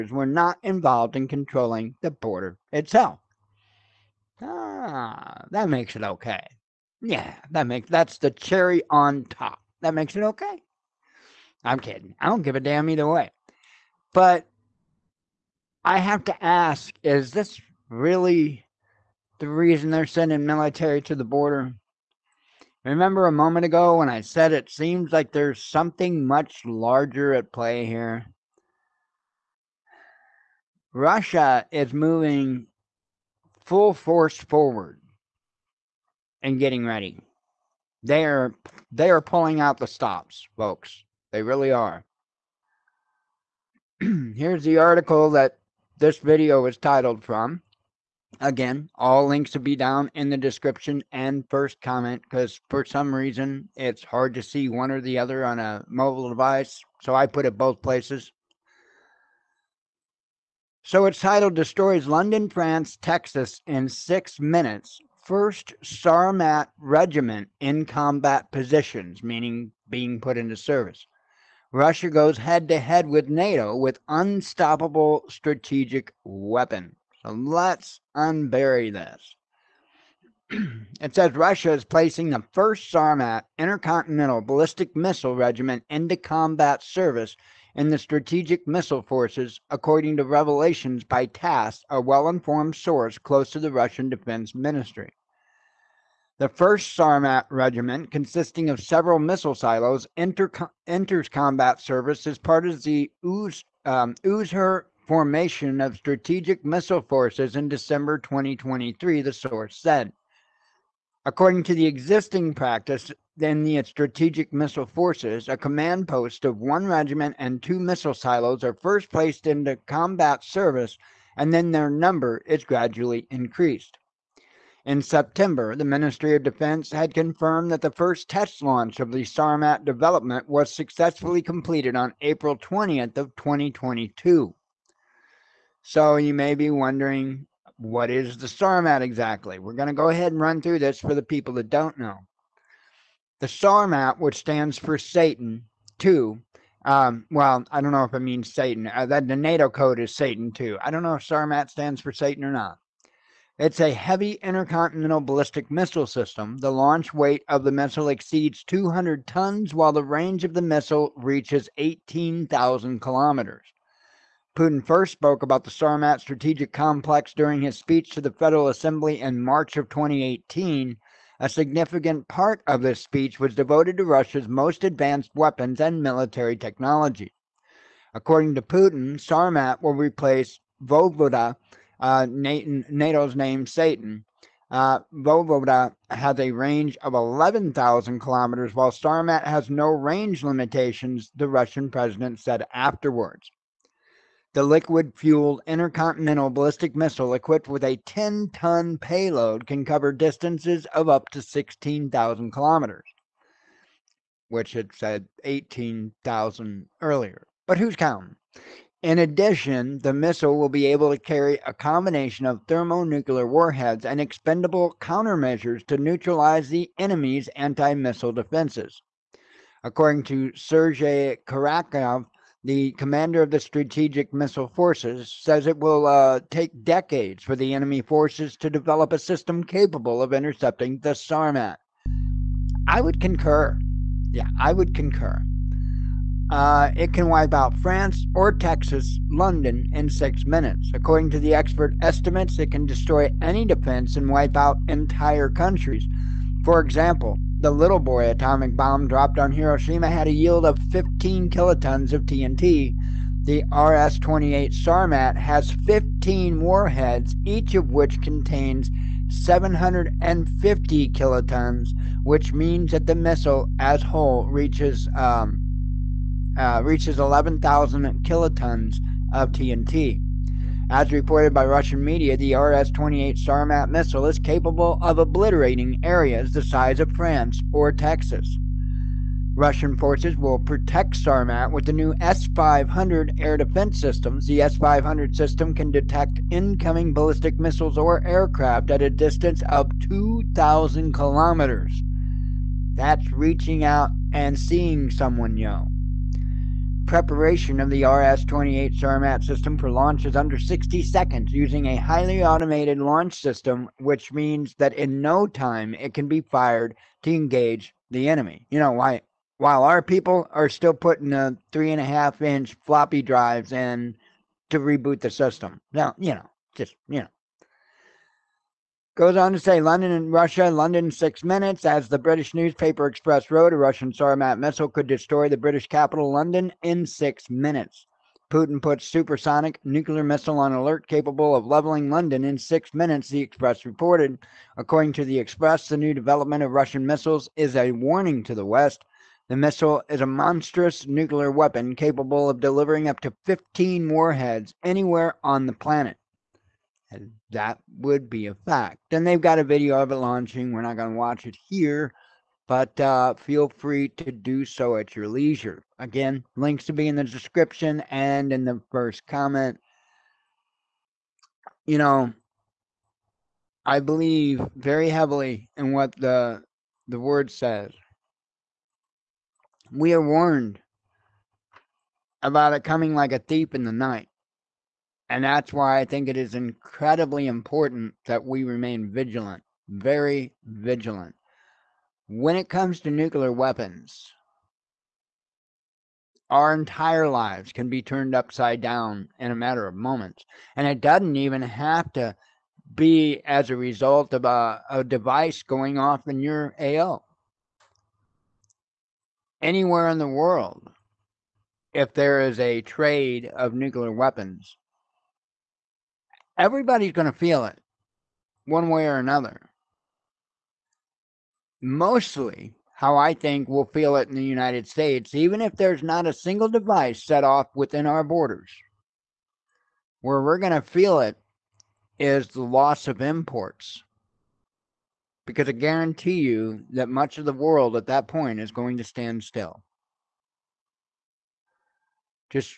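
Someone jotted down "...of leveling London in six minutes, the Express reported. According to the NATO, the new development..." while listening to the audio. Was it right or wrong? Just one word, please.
wrong.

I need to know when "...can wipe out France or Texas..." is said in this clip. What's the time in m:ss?
3:57.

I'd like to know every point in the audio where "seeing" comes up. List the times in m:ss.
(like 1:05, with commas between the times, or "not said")
4:54.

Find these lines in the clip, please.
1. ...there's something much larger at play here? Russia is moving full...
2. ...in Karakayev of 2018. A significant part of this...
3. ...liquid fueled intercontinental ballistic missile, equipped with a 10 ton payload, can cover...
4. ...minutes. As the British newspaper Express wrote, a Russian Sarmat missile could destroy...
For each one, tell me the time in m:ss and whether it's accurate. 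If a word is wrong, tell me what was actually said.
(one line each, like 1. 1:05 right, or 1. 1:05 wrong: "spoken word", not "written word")
1. 0:25 right
2. 2:49 wrong: "March", not "Karakayev"
3. 3:14 right
4. 5:21 right.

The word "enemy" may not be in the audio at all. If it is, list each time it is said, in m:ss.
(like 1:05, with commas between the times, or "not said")
3:36, 3:47, 5:08.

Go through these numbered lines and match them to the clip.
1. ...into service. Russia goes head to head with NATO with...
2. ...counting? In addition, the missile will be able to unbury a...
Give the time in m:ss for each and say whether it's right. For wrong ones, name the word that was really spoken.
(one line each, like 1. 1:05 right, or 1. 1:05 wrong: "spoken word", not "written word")
1. 1:10 right
2. 3:27 wrong: "carry", not "unbury".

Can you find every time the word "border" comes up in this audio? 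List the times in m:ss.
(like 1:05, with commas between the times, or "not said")
0:02, 0:21, 6:58.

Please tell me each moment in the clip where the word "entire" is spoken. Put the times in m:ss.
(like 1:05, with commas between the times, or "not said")
4:04, 6:26.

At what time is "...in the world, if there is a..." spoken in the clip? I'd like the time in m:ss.
6:40.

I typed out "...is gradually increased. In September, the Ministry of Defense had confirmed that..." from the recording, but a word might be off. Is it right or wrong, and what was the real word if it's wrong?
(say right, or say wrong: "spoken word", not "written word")
right.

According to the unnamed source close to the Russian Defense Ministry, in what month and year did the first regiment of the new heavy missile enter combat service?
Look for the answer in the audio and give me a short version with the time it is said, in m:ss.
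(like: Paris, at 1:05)
December 2023, at 1:47.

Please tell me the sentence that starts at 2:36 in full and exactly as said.
The launch weight of the missile exceeds 200 tons, while the range of the missile reaches 18,000 kilometers.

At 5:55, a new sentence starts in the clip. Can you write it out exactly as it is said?
Again, links to be in the description and in the first comment.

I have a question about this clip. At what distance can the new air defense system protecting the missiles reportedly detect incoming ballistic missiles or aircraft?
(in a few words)
2,000 kilometers.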